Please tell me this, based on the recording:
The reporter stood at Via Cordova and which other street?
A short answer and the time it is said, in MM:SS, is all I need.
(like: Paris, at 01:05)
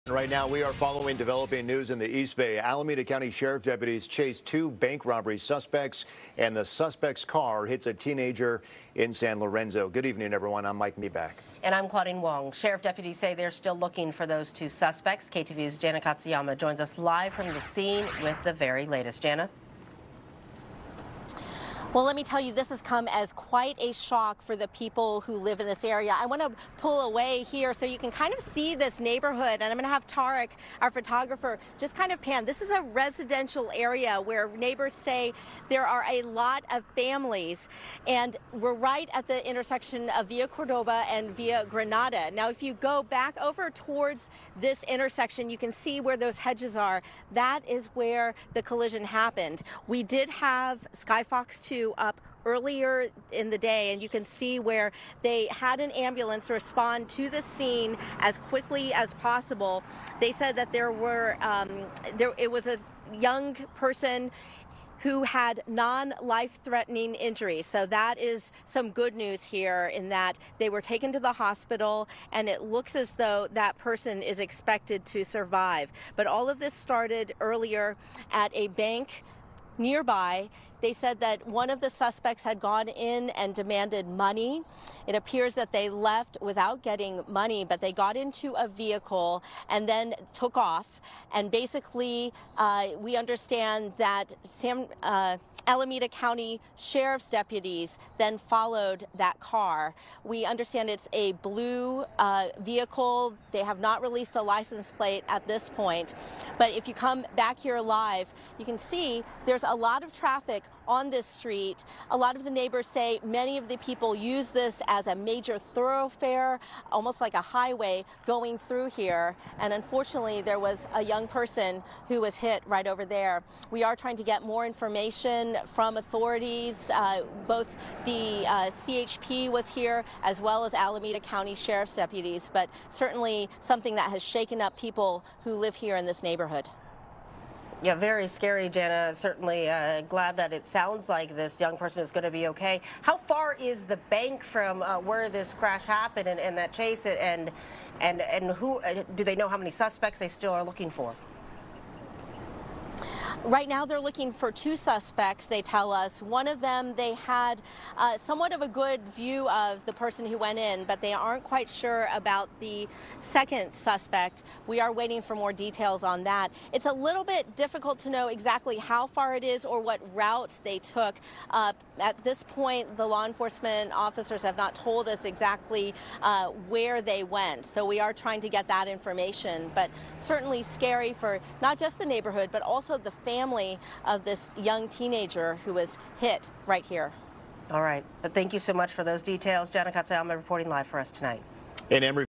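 Via Granada, at 00:41.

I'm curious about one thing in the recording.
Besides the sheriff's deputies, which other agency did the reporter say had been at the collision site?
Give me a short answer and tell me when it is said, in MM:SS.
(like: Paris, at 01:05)
CHP, at 02:08.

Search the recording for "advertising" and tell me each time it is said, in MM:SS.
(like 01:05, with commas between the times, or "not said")
not said.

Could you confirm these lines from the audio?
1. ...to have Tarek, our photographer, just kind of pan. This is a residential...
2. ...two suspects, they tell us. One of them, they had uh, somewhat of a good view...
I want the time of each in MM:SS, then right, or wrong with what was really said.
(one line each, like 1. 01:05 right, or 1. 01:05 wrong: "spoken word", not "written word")
1. 00:29 right
2. 02:34 right.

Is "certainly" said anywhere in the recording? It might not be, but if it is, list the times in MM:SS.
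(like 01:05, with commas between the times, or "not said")
02:12, 02:19, 03:00.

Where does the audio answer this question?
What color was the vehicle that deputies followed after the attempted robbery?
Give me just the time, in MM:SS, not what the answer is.
01:41.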